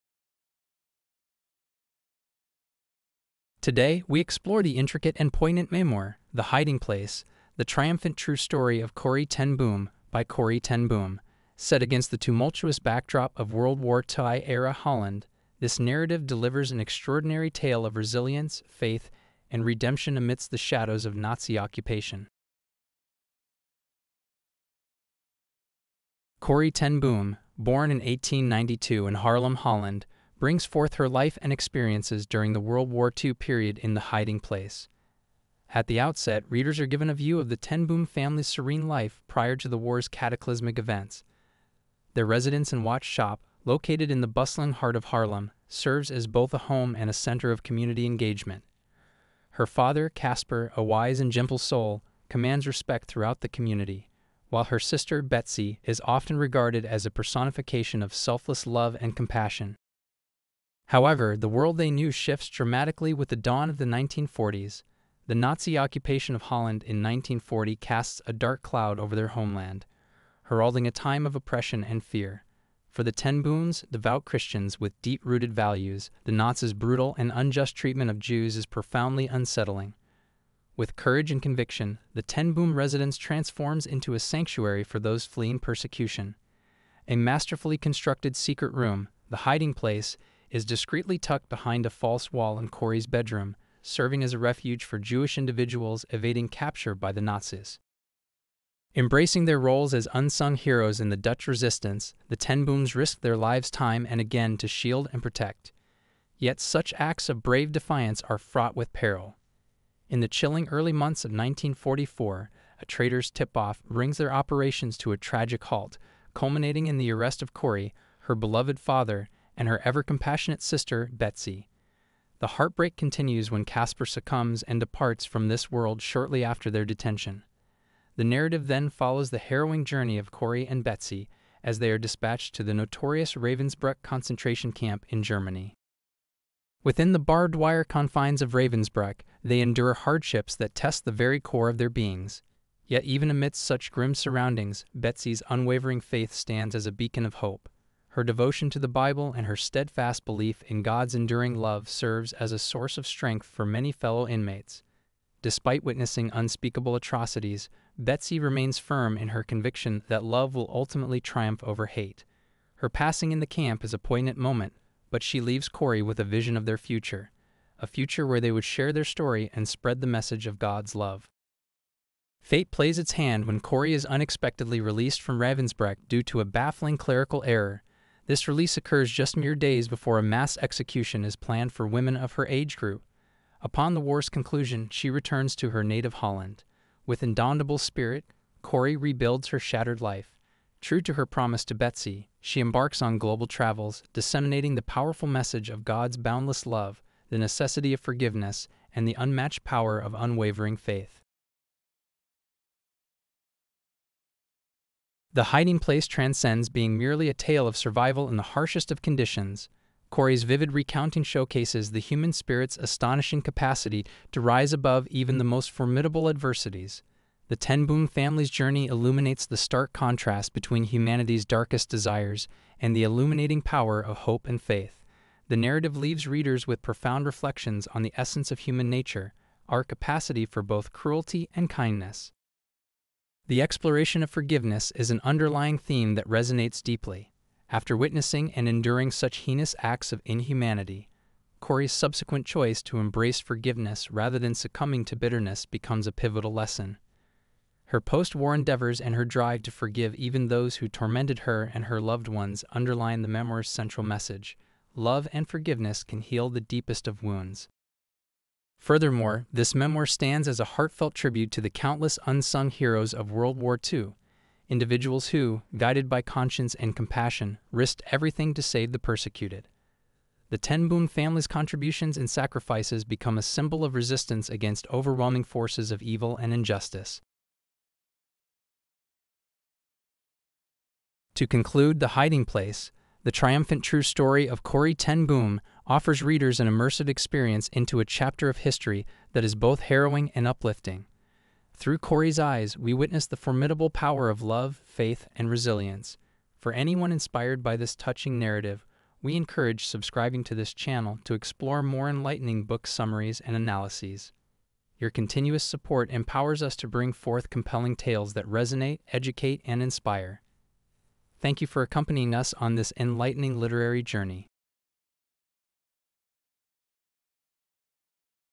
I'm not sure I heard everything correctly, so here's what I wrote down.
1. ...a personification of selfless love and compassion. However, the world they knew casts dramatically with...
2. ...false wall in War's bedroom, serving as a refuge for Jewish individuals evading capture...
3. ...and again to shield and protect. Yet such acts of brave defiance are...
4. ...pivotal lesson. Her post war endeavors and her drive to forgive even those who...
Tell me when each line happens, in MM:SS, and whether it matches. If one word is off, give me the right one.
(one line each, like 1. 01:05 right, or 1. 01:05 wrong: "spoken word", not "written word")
1. 00:57 wrong: "shifts", not "casts"
2. 01:31 wrong: "Corrie", not "War"
3. 01:44 right
4. 04:06 right.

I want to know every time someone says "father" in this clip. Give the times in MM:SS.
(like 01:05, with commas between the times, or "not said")
00:49, 01:58.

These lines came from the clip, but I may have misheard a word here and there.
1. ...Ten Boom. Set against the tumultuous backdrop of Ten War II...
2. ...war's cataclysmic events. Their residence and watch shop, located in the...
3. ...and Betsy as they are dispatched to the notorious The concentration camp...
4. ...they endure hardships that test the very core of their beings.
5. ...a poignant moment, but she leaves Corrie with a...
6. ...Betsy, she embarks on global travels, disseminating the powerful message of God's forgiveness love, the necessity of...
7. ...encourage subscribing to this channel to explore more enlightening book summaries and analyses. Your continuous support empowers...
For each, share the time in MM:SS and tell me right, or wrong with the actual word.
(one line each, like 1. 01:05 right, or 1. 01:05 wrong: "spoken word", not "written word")
1. 00:10 wrong: "World", not "Ten"
2. 00:39 right
3. 02:10 wrong: "Ravensbrück", not "The"
4. 02:19 right
5. 02:43 right
6. 03:11 wrong: "boundless", not "forgiveness"
7. 04:59 right.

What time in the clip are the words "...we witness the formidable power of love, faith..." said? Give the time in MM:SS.
04:52.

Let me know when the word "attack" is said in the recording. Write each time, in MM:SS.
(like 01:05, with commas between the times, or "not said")
not said.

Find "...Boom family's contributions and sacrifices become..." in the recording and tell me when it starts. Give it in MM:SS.
04:30.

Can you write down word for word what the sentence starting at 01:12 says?
For the Ten Booms, devout Christians with deep rooted values, the Nazis' brutal and unjust treatment of Jews is profoundly unsettling.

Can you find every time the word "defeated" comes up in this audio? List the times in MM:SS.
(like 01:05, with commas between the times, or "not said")
not said.